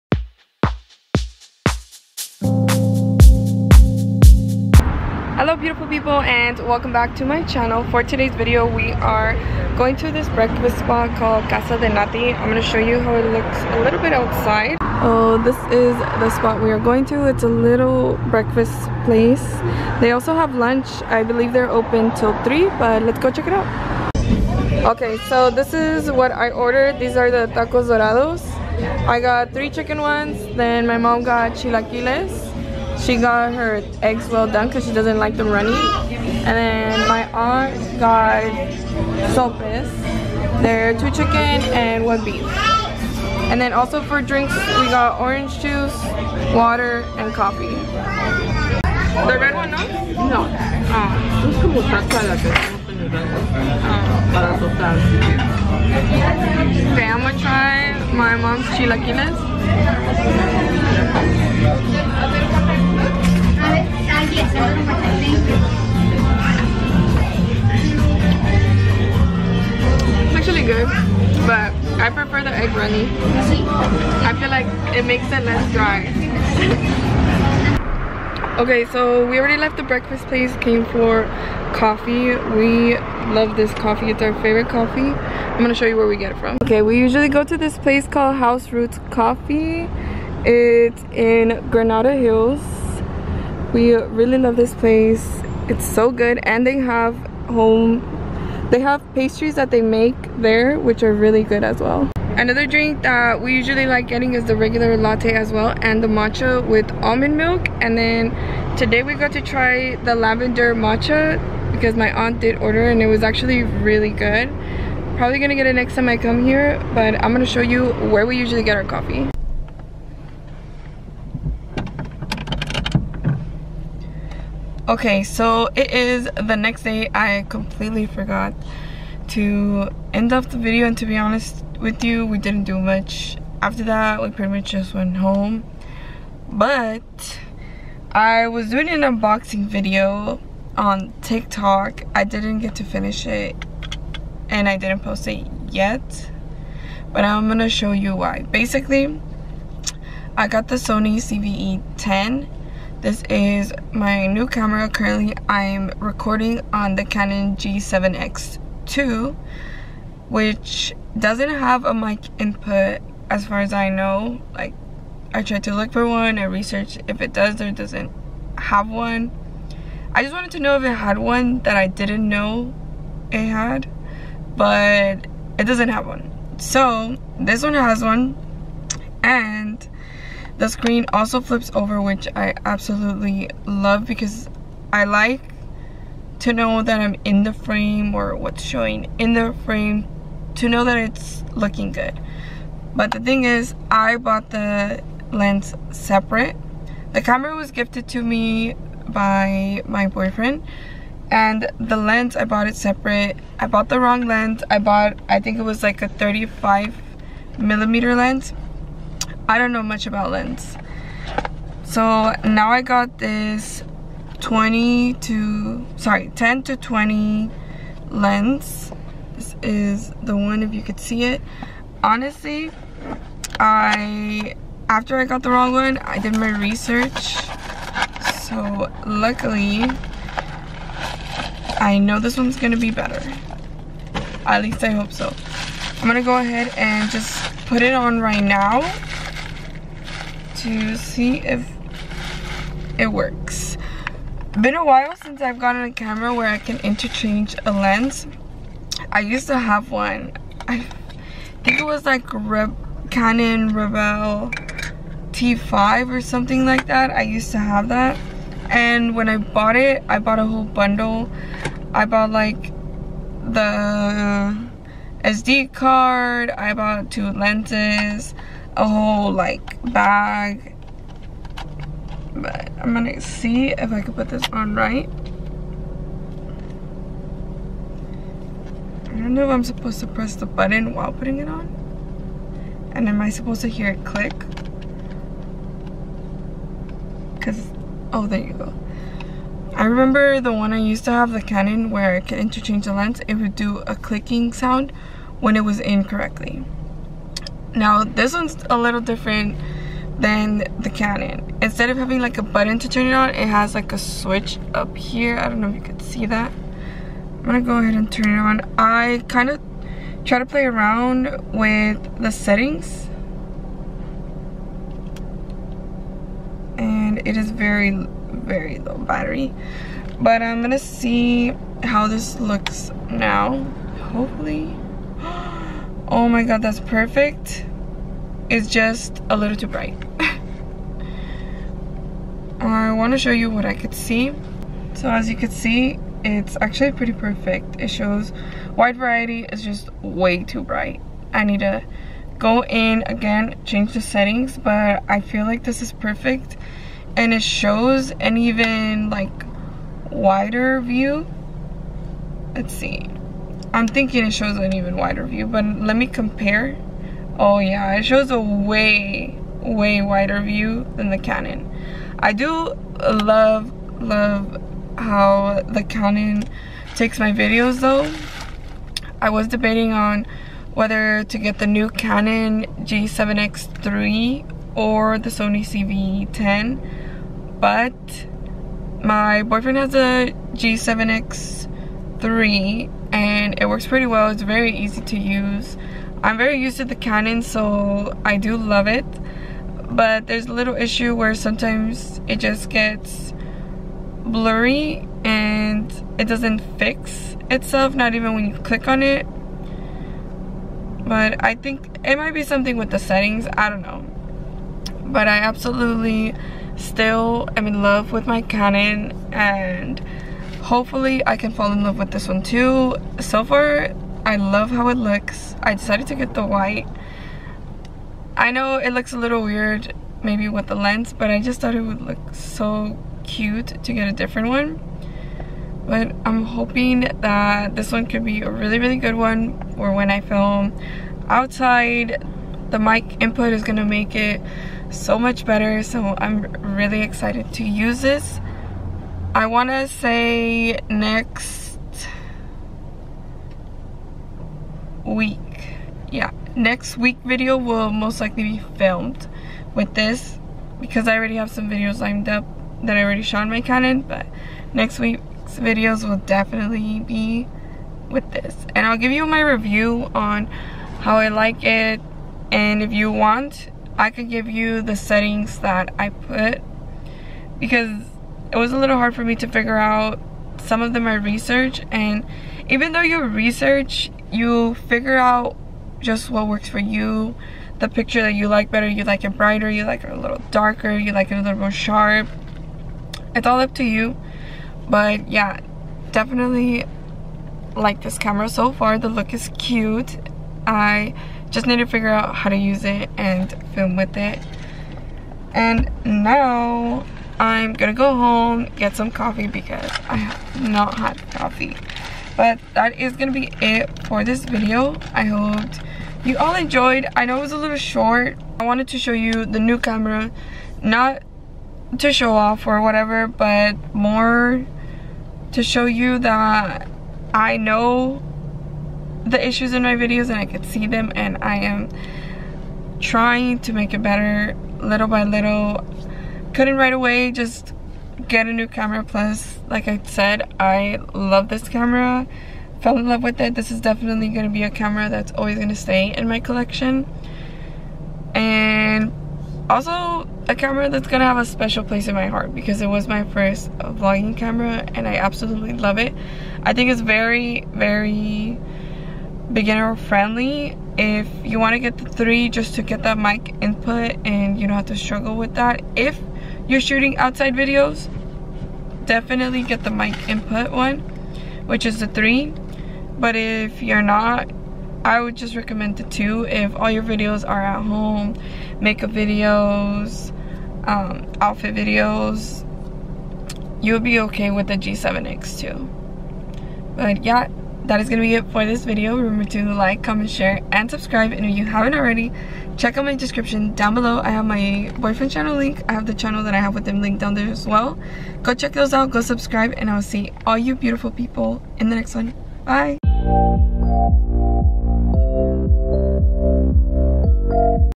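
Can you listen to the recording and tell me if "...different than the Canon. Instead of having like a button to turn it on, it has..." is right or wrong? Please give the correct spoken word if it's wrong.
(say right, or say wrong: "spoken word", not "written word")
right.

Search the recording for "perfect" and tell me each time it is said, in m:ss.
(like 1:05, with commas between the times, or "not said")
5:26, 5:37, 5:45.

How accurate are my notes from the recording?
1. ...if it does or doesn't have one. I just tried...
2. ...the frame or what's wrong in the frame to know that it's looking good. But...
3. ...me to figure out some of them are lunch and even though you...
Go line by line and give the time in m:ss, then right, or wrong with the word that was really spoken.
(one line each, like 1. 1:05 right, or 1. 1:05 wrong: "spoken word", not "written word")
1. 2:47 wrong: "wanted", not "tried"
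2. 3:07 wrong: "showing", not "wrong"
3. 7:49 wrong: "research", not "lunch".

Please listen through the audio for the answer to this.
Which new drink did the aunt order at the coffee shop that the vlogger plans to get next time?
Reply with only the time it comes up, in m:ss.
1:50.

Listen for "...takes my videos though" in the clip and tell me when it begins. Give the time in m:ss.
6:06.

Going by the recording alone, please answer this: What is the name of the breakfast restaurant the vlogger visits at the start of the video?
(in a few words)
Casa de Nati.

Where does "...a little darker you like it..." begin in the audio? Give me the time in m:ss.
8:00.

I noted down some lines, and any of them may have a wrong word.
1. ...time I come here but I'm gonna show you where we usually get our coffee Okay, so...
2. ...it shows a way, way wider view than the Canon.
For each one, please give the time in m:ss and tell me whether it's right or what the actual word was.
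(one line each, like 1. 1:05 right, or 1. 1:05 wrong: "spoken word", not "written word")
1. 1:55 right
2. 5:57 right.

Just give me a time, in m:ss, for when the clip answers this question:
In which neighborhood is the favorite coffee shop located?
1:31.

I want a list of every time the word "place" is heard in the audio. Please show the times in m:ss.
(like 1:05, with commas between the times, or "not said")
0:19, 1:20, 1:27, 1:34, 9:01.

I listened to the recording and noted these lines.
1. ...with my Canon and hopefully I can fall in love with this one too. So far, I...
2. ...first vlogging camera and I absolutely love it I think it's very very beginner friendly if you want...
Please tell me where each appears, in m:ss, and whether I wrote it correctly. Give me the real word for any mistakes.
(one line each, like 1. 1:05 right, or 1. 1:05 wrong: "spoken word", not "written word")
1. 6:48 right
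2. 9:03 right.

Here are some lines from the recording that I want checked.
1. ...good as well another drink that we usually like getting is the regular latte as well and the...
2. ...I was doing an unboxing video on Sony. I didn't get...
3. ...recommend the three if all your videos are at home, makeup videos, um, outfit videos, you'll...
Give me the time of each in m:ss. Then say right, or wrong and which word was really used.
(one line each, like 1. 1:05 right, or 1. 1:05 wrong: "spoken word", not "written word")
1. 1:41 right
2. 2:18 wrong: "TikTok", not "Sony"
3. 9:25 wrong: "two", not "three".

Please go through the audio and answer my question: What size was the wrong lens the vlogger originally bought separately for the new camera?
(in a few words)
35 millimeter.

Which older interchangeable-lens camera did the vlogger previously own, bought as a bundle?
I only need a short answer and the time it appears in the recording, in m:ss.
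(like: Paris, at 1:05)
Canon Rebel T5, at 4:13.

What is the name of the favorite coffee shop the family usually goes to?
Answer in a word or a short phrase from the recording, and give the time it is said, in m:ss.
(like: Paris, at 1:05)
House Roots Coffee, at 1:28.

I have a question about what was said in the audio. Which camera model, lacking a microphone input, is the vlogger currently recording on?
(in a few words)
Canon G7X2.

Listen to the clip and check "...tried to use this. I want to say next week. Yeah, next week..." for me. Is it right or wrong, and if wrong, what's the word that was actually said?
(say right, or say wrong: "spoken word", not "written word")
wrong: "excited", not "tried".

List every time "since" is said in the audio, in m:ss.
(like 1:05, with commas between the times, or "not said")
4:05.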